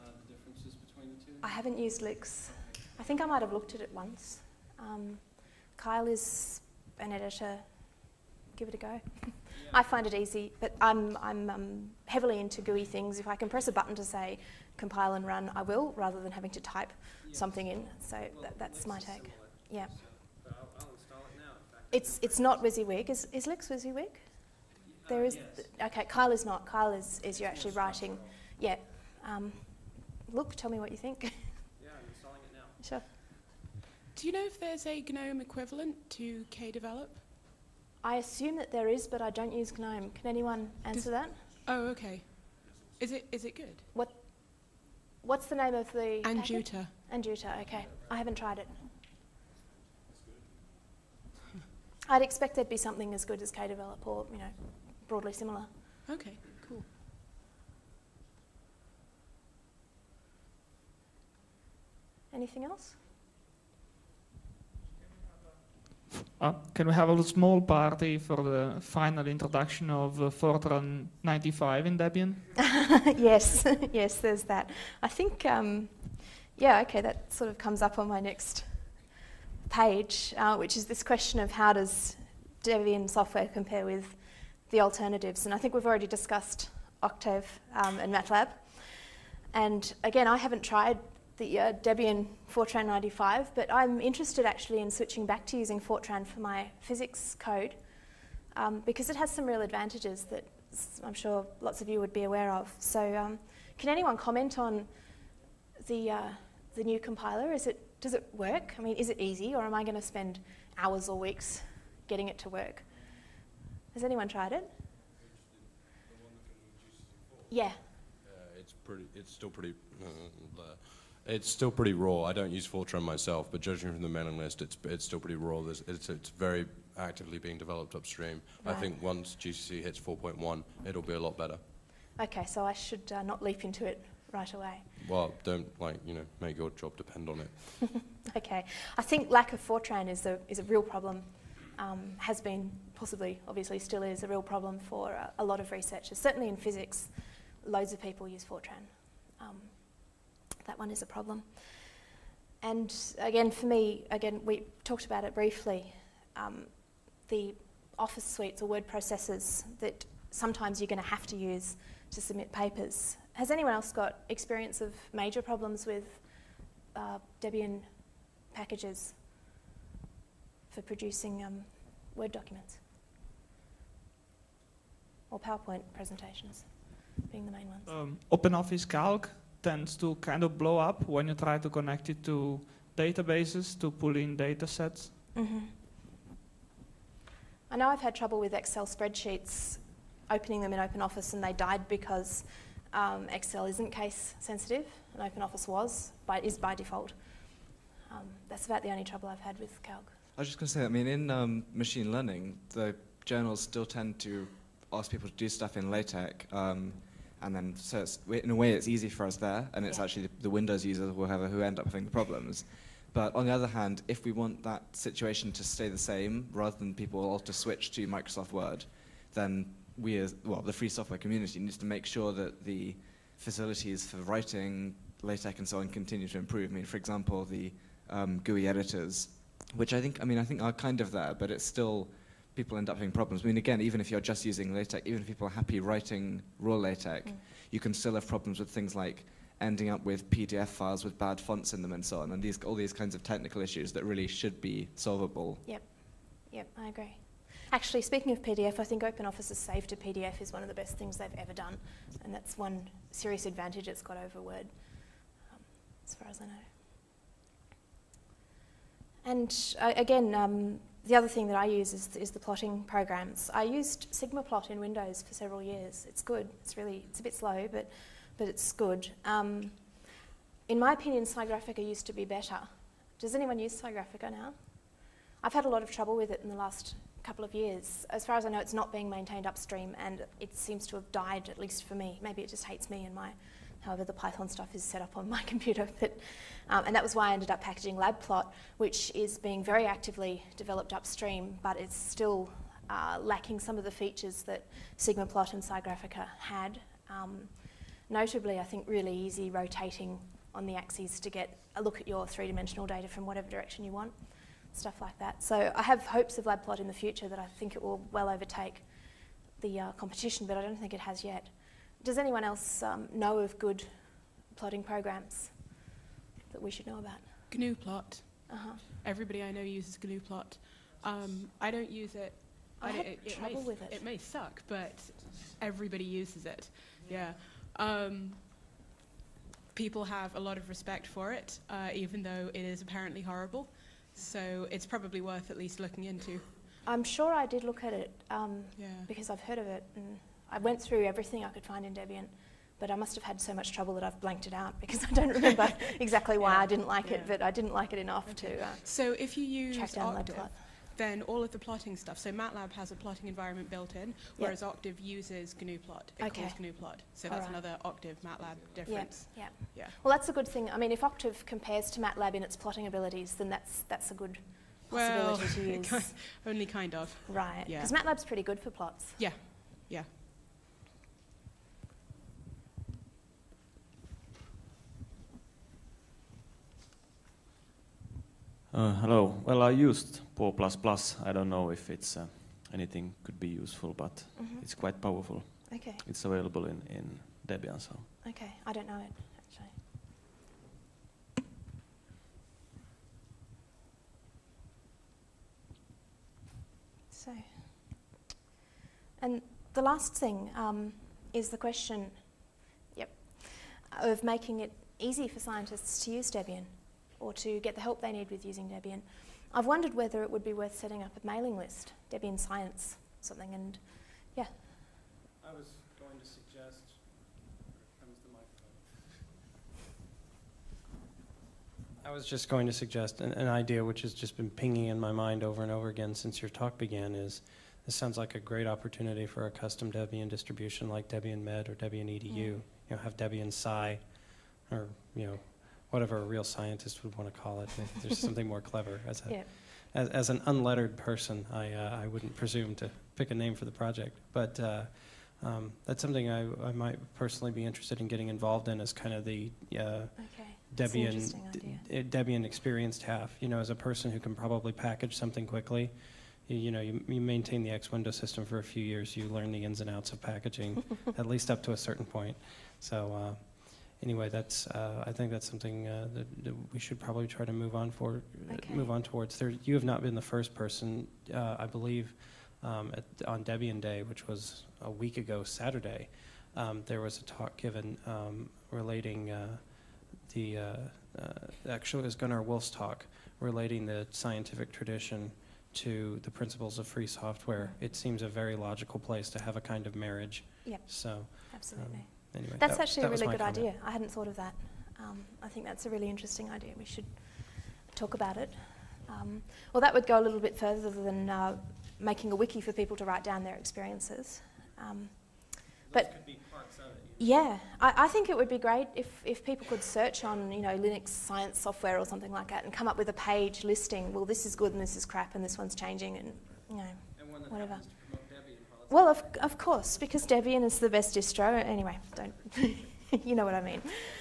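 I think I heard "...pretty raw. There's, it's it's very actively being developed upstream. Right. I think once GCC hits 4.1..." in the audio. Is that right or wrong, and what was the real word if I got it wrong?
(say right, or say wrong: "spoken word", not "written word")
right.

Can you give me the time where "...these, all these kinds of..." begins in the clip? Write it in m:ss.
4:02.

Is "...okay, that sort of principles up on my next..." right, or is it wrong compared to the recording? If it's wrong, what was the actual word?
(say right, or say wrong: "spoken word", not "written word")
wrong: "comes", not "principles".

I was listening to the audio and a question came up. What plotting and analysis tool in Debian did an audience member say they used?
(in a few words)
Paw++.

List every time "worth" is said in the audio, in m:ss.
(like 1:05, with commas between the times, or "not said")
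5:35, 6:50.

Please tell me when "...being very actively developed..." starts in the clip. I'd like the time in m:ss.
4:49.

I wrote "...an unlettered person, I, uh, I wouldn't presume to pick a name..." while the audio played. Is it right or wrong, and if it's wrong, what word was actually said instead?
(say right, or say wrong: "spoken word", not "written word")
right.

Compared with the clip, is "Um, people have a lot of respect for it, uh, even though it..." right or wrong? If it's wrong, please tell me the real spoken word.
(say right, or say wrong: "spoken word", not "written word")
right.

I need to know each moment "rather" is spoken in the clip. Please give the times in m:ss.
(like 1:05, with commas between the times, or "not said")
0:15, 3:36.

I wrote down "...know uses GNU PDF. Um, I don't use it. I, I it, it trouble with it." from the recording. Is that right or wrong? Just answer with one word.
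wrong.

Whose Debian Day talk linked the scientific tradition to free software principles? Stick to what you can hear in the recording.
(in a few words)
Gunnar Wolf.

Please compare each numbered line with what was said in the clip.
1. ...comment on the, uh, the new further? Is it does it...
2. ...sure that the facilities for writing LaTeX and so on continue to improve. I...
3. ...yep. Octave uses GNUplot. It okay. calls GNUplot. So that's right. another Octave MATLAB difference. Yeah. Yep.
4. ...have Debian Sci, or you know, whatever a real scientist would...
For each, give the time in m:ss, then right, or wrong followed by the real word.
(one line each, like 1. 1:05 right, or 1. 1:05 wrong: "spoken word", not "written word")
1. 1:44 wrong: "compiler", not "further"
2. 3:42 right
3. 5:54 right
4. 7:12 right.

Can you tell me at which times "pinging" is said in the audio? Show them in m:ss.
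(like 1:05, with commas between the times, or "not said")
7:04.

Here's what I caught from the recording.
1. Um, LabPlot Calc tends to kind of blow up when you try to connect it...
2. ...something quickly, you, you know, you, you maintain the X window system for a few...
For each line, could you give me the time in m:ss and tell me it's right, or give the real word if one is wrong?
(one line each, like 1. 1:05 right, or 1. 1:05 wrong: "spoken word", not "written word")
1. 2:57 wrong: "OpenOffice", not "LabPlot"
2. 7:35 right.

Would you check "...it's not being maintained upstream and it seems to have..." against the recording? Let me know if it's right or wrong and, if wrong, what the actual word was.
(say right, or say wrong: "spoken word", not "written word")
right.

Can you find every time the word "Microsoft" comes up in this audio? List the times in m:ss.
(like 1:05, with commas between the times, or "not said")
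3:38.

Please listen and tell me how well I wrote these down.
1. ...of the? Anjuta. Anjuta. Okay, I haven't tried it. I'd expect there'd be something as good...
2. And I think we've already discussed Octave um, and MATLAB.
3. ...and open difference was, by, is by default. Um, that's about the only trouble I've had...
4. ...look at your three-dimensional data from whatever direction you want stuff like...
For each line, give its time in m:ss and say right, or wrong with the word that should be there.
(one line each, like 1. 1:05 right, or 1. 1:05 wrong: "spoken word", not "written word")
1. 0:45 right
2. 1:25 right
3. 3:15 wrong: "office", not "difference"
4. 5:01 right.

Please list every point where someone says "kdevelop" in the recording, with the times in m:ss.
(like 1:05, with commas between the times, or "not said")
0:36.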